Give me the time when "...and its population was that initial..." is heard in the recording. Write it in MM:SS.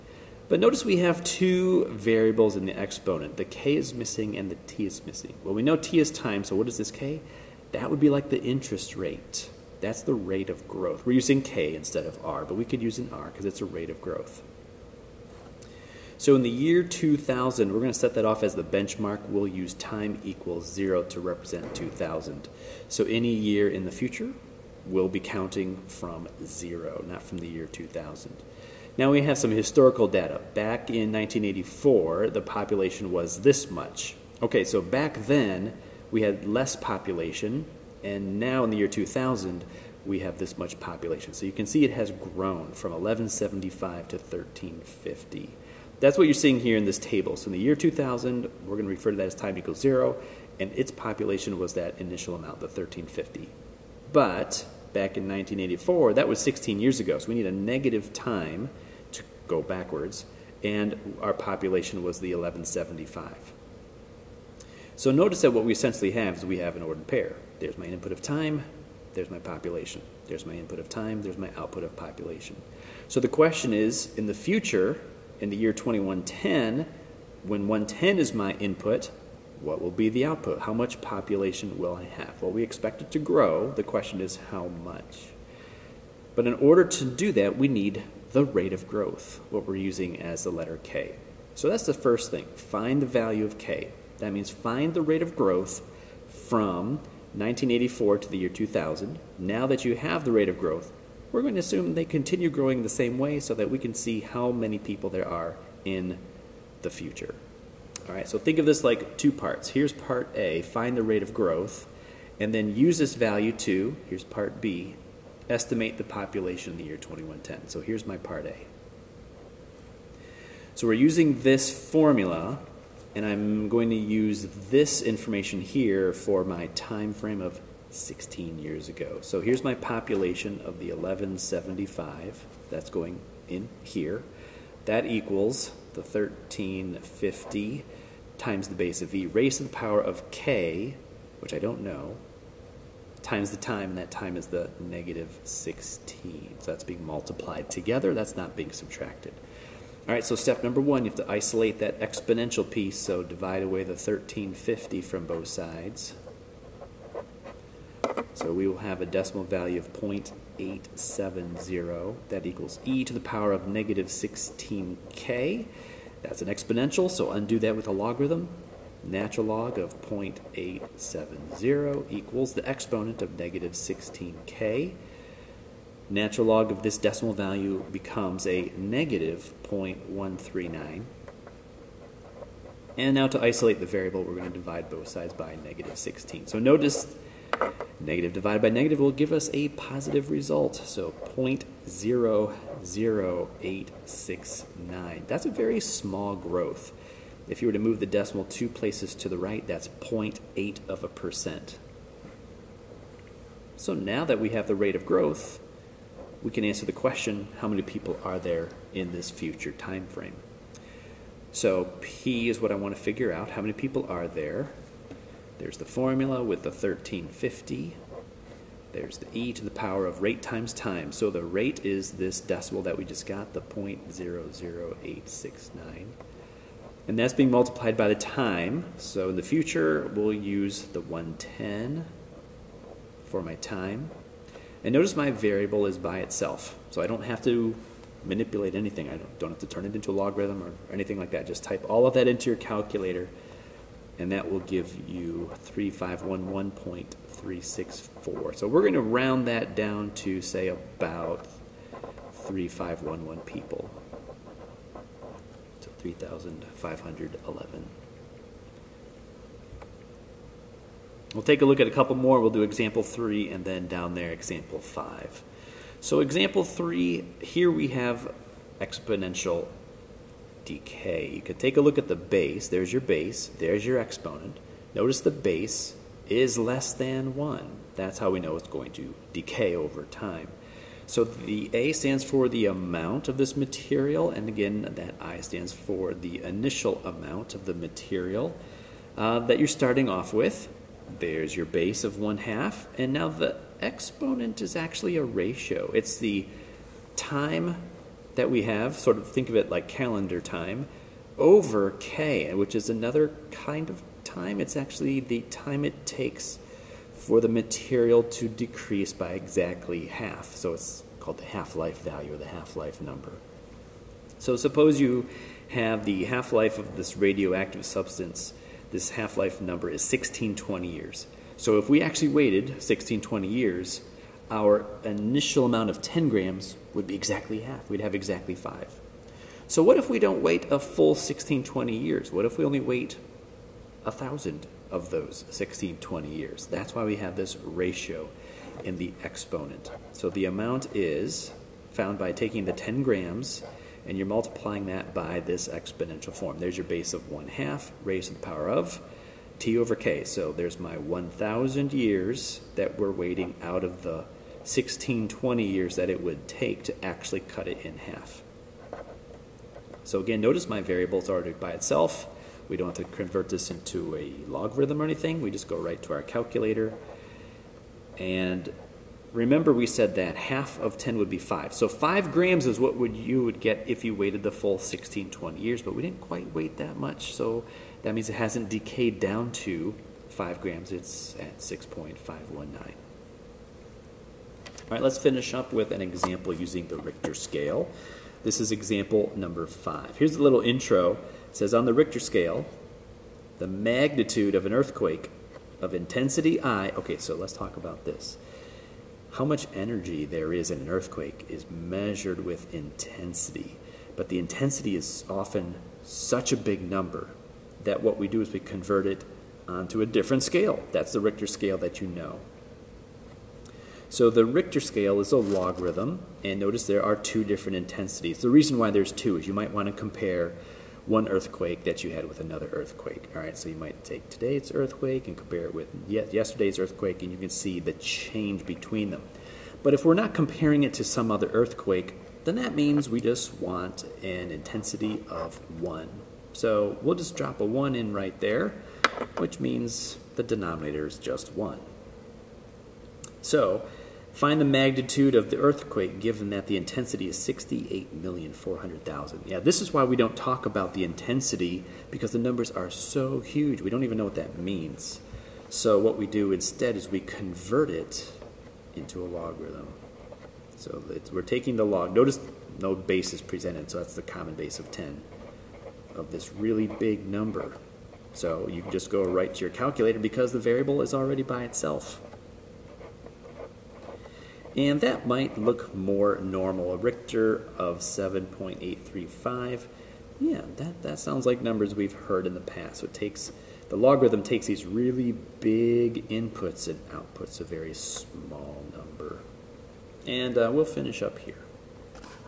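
00:50.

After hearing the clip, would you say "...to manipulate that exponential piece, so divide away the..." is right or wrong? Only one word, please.
wrong.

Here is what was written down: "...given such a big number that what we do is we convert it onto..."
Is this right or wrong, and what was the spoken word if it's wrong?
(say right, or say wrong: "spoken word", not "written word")
wrong: "often", not "given".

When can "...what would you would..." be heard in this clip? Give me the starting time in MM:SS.
06:12.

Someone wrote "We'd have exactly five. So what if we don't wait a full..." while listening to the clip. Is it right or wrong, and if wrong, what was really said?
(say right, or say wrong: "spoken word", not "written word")
right.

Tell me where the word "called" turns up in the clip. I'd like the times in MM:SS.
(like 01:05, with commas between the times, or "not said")
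05:11.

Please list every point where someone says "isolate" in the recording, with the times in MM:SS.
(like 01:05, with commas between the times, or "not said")
02:31, 03:03.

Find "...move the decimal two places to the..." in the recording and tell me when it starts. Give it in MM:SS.
03:17.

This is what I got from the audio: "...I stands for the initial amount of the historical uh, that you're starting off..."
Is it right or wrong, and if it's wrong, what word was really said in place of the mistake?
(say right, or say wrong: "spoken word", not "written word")
wrong: "material", not "historical".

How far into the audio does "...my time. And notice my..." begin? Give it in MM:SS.
03:53.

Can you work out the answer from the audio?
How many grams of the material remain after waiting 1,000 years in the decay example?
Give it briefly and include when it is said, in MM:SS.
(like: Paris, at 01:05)
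6.519, at 06:21.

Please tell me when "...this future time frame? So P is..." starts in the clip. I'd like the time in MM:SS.
03:29.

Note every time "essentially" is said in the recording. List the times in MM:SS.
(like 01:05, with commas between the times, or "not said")
01:05.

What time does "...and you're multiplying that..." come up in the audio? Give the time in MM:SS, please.
05:44.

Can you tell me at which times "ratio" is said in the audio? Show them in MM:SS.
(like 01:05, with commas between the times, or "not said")
04:55, 05:37.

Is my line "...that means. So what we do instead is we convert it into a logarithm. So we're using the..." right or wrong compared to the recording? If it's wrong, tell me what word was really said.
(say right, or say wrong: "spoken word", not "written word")
wrong: "taking", not "using".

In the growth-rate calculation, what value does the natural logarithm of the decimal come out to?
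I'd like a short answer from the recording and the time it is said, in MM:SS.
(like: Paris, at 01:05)
-0.139, at 02:58.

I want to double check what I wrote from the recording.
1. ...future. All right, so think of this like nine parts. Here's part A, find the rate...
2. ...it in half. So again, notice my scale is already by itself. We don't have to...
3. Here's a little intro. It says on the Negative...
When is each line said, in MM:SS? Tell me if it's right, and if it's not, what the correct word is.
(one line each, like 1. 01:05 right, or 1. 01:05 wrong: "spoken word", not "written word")
1. 01:46 wrong: "two", not "nine"
2. 05:57 wrong: "variable", not "scale"
3. 06:30 wrong: "Richter", not "Negative".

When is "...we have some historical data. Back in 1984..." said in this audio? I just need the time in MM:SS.
00:29.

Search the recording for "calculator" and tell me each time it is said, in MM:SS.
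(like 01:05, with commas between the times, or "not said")
04:02, 06:06, 07:49.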